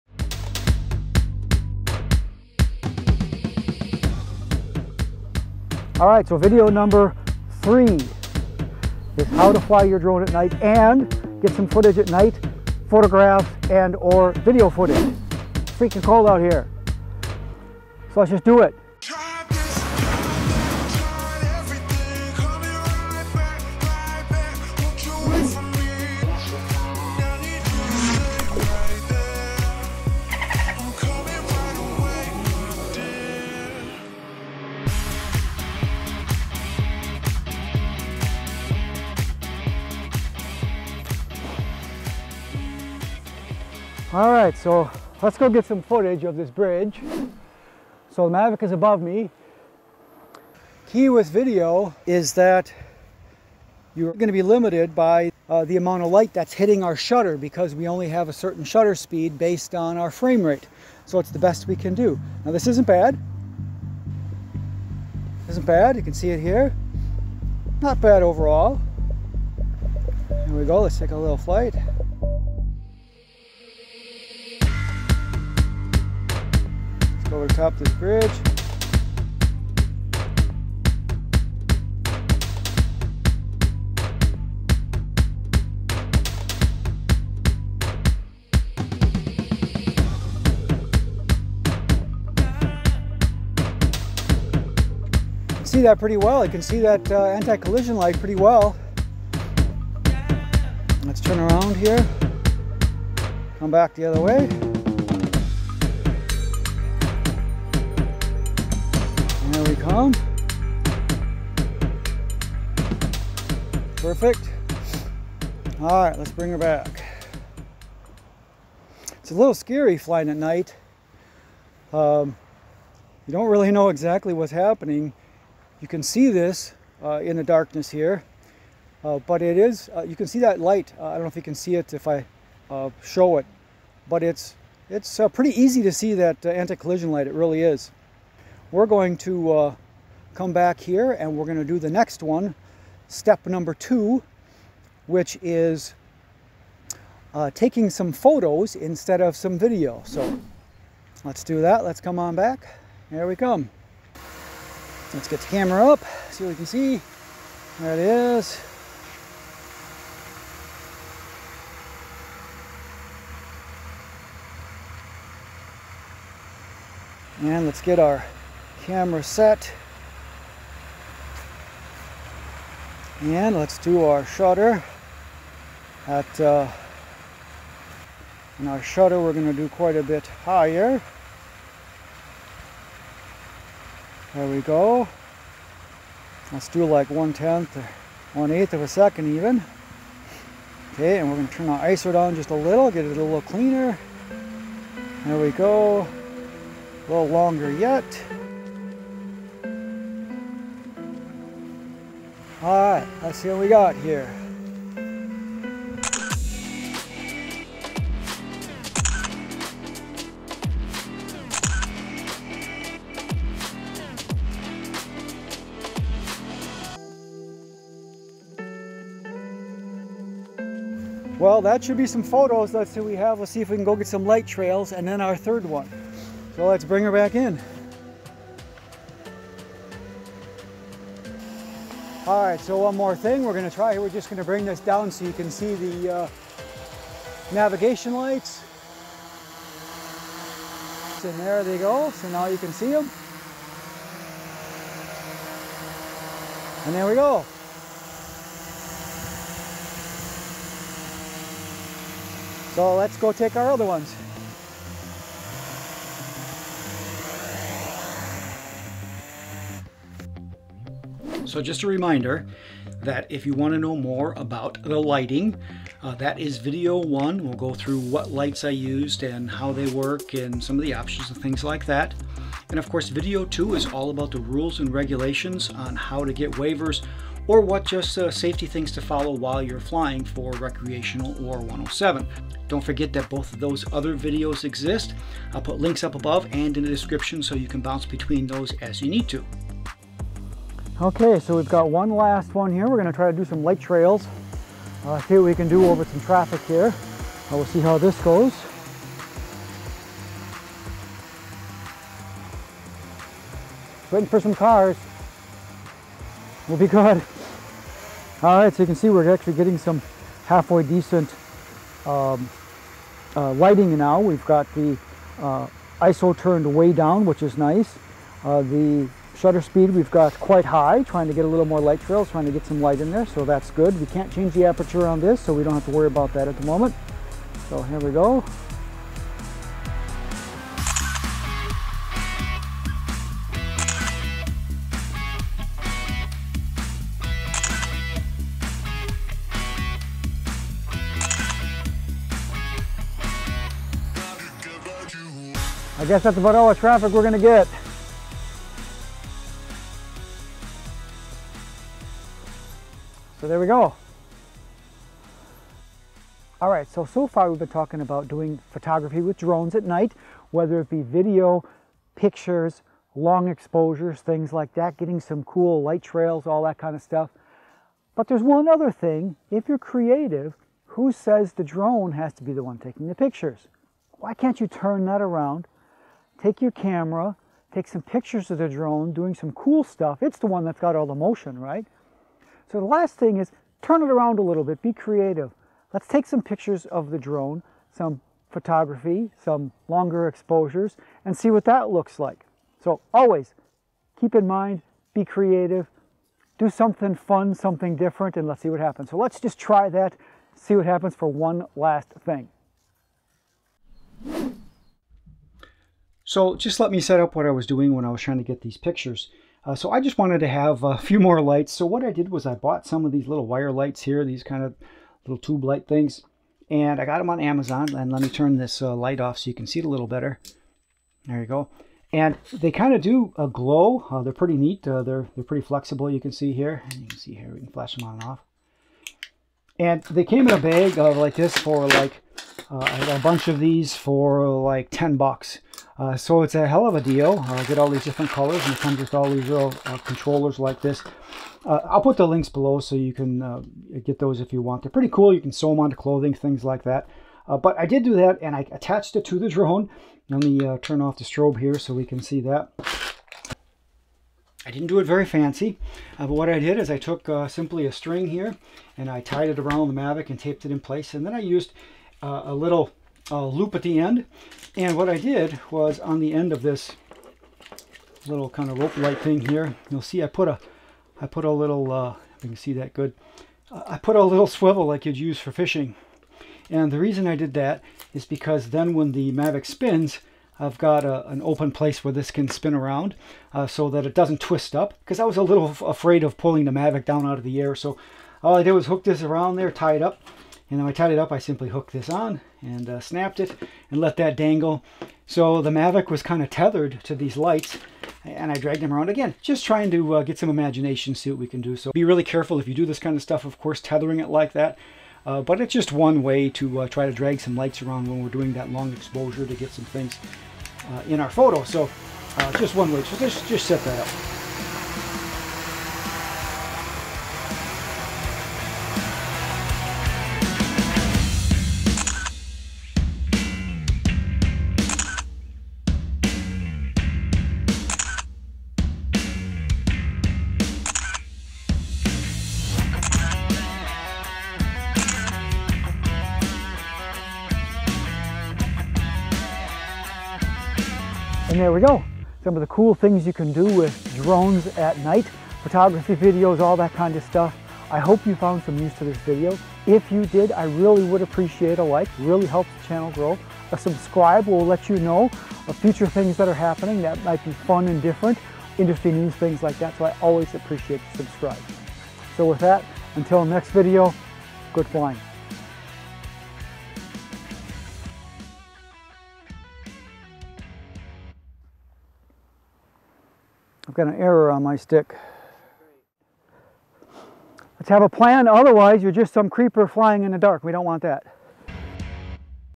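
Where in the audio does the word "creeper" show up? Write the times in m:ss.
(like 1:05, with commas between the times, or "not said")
9:39.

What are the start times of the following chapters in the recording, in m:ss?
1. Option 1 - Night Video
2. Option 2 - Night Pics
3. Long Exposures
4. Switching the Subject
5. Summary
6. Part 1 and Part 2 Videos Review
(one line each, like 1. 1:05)
1. 0:46
2. 2:31
3. 4:50
4. 5:55
5. 9:00
6. 4:19.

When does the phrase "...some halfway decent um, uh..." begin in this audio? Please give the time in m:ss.
5:09.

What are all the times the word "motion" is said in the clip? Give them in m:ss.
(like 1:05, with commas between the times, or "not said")
6:21.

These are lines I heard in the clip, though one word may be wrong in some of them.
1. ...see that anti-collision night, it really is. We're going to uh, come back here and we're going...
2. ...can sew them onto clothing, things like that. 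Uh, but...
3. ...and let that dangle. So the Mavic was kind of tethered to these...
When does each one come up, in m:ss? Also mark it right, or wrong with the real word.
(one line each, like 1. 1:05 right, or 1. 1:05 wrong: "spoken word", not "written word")
1. 2:15 wrong: "light", not "night"
2. 7:25 right
3. 8:13 right.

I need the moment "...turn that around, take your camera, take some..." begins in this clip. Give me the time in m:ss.
6:14.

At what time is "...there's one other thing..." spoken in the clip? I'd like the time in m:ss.
6:08.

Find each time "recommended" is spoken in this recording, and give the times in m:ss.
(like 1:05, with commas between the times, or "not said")
not said.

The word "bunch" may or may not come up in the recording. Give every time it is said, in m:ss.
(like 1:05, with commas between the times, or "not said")
7:13.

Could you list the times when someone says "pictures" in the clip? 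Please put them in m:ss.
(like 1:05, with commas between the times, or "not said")
6:02, 6:13, 6:18, 6:26, 6:48.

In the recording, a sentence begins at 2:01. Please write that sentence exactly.
Um, you don't really know exactly what's happening.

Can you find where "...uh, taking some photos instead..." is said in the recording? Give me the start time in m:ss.
2:27.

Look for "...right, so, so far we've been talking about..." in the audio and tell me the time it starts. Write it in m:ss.
5:56.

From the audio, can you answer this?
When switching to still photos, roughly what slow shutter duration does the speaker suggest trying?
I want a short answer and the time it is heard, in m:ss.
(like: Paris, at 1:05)
1/10 or 1/8 second, at 3:07.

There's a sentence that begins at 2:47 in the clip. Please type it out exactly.
And let's get our camera set.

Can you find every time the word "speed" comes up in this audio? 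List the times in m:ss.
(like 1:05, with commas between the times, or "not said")
0:58, 5:19.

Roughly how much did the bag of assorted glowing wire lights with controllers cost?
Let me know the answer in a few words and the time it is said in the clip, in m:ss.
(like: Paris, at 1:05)
$10, at 7:14.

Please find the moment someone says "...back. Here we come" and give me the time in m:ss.
2:32.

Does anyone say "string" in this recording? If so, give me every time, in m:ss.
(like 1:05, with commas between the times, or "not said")
7:37.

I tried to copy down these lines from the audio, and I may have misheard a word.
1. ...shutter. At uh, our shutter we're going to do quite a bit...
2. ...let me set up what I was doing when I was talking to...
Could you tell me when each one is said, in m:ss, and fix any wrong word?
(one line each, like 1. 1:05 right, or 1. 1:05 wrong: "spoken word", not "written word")
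1. 2:54 right
2. 6:46 wrong: "trying", not "talking".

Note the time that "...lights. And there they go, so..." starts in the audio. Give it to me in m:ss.
3:58.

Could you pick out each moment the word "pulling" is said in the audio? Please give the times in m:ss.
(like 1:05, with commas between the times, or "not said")
8:06.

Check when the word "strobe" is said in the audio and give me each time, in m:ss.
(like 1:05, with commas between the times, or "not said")
7:31.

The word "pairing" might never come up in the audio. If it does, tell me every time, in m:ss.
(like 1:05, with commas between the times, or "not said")
not said.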